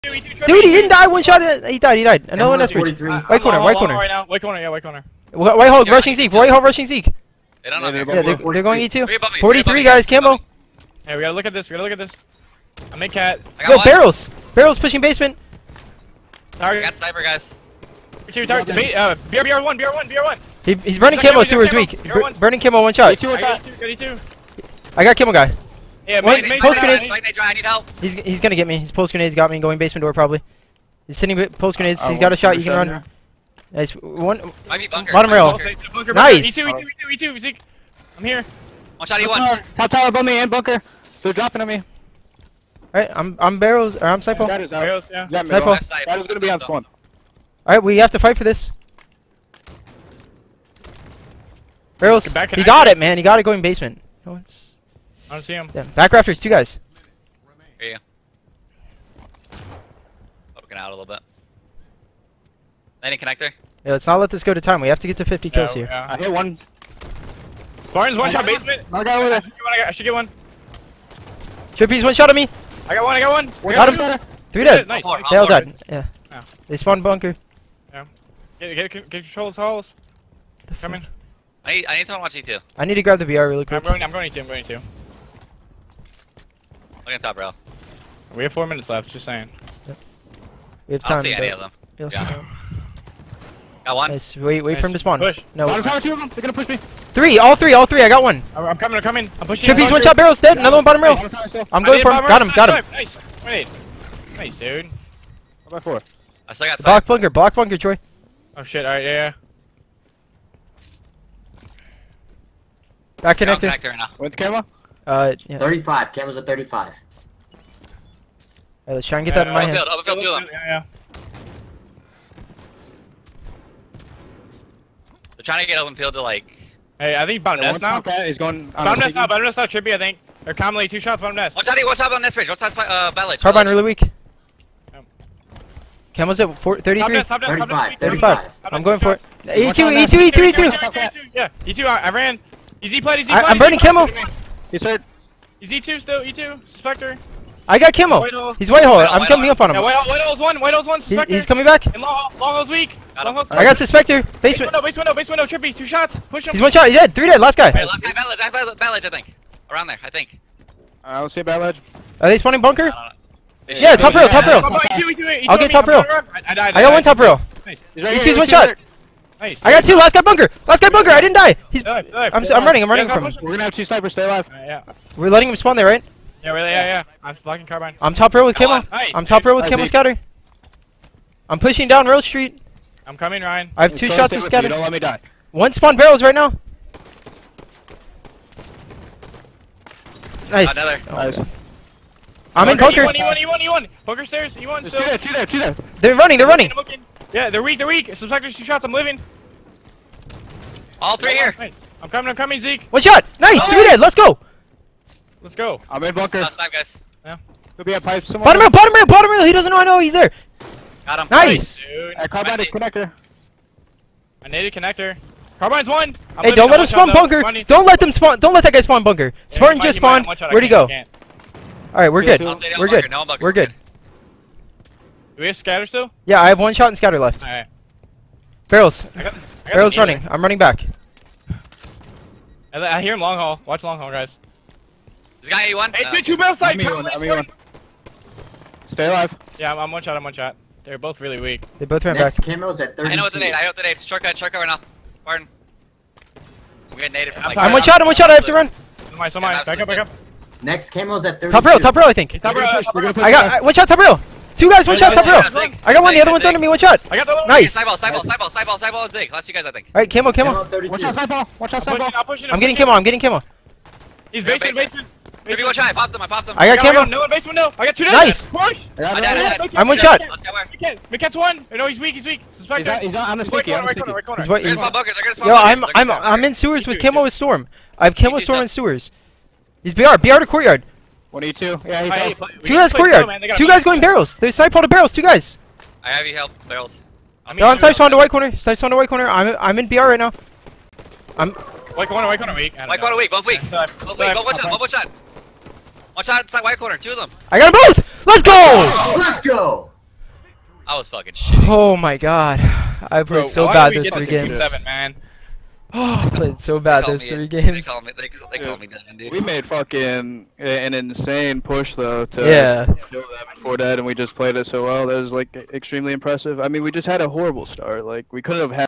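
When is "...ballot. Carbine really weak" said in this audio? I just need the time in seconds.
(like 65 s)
133 s.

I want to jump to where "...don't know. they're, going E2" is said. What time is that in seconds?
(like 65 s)
7 s.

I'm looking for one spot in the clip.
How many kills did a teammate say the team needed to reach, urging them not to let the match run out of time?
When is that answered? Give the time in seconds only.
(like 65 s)
64 s.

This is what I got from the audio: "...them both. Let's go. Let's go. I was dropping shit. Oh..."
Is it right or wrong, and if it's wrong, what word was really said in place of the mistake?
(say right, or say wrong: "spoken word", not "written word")
wrong: "fucking", not "dropping".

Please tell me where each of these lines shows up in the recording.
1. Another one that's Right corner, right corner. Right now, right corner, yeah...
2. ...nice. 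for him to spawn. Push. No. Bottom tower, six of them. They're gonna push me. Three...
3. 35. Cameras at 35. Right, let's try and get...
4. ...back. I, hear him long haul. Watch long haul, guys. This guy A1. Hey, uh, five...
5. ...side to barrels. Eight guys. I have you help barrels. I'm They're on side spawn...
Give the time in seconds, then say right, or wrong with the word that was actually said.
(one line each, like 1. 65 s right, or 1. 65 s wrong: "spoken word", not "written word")
1. 2 s right
2. 94 s wrong: "two", not "six"
3. 115 s right
4. 230 s wrong: "two", not "five"
5. 284 s wrong: "Two", not "Eight".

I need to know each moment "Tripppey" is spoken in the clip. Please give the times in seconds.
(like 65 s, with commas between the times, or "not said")
71 s, 99 s, 155 s.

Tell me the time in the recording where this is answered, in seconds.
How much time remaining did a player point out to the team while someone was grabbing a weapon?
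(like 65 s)
88 s.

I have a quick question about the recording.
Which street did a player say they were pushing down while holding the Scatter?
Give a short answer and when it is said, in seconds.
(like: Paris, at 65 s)
Rose Street, at 181 s.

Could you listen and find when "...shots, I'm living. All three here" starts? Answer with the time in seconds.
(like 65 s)
198 s.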